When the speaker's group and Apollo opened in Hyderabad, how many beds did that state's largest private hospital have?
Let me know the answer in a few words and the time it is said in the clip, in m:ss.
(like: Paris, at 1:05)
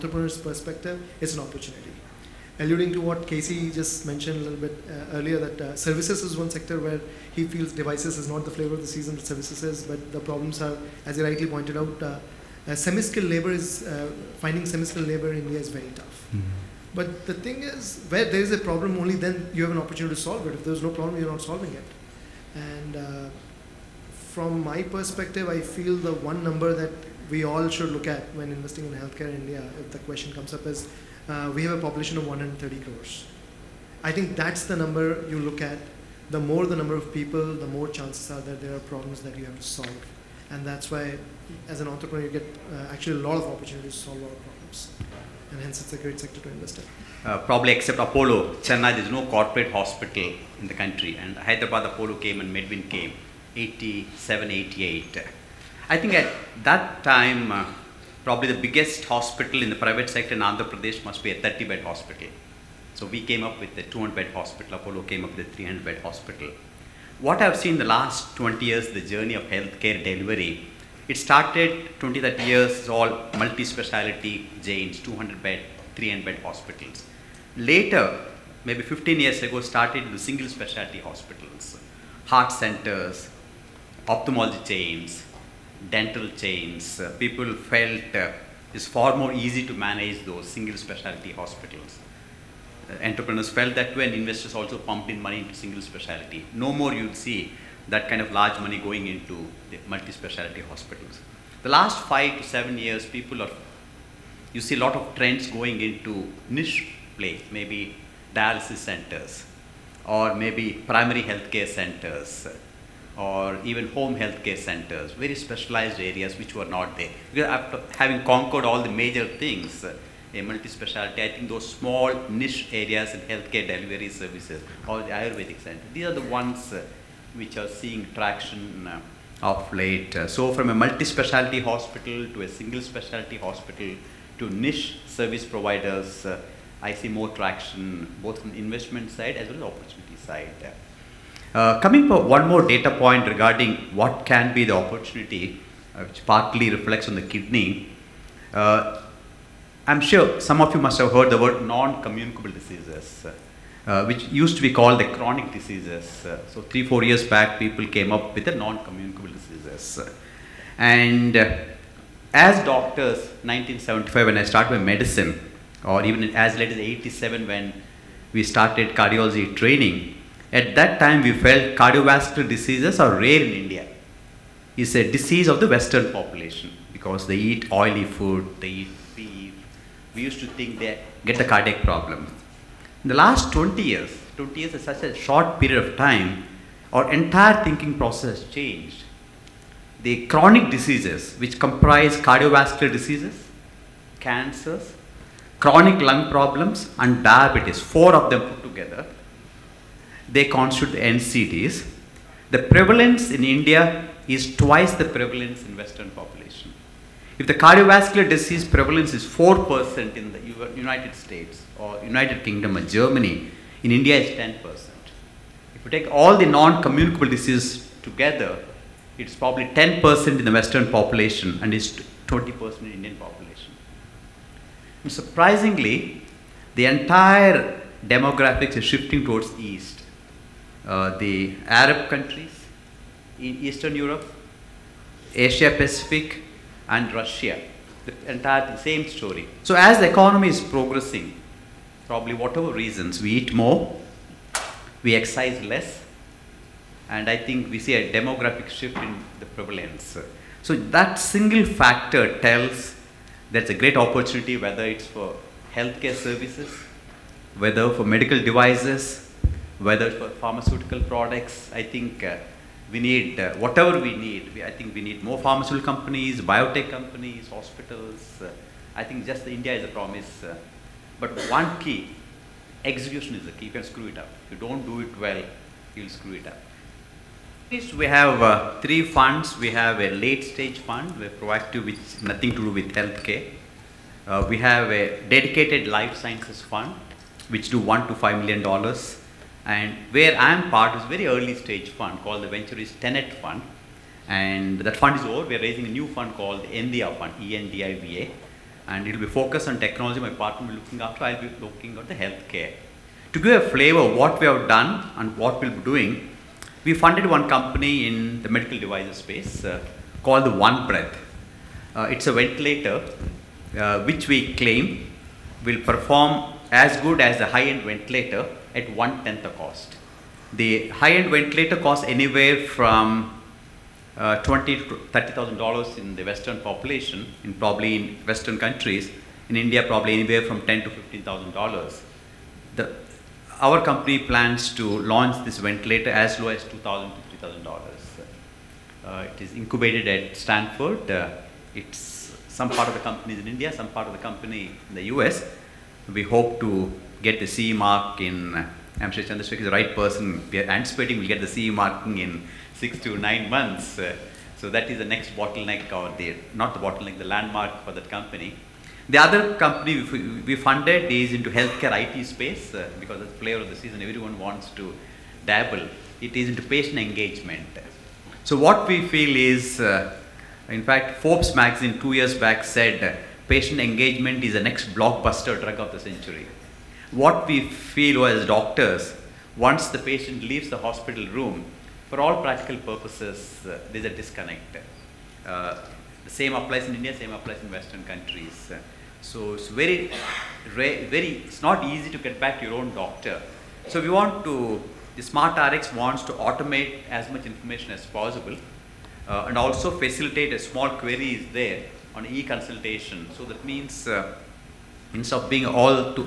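30, at 1:01.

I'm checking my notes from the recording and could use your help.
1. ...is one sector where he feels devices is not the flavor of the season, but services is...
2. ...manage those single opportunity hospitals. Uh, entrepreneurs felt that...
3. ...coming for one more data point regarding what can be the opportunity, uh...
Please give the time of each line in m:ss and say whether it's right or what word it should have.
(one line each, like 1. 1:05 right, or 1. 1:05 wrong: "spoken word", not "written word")
1. 0:06 right
2. 1:29 wrong: "specialty", not "opportunity"
3. 2:21 right.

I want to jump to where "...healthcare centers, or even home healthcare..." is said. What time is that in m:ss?
1:51.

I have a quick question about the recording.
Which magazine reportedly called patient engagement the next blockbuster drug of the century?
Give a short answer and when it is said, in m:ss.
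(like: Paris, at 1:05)
Forbes, at 6:11.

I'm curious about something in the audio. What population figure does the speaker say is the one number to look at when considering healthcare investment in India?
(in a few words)
130 crores.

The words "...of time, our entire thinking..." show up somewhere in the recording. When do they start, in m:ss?
3:05.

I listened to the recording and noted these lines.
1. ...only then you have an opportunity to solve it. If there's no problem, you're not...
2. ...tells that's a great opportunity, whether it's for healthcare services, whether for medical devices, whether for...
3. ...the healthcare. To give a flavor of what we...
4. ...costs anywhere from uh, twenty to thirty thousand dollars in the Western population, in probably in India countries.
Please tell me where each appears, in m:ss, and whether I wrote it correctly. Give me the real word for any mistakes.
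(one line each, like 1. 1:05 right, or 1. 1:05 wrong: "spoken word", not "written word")
1. 0:19 right
2. 4:12 right
3. 5:02 right
4. 5:21 wrong: "Western", not "India".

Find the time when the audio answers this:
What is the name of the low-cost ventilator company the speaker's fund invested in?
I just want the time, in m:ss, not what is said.
5:10.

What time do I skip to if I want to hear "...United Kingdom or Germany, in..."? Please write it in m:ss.
3:32.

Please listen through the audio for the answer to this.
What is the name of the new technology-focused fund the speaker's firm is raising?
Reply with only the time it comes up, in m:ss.
4:56.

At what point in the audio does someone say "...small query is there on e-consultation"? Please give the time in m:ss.
6:40.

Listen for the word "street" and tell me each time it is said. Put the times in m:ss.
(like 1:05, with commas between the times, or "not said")
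not said.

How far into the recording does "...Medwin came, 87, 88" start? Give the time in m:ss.
0:52.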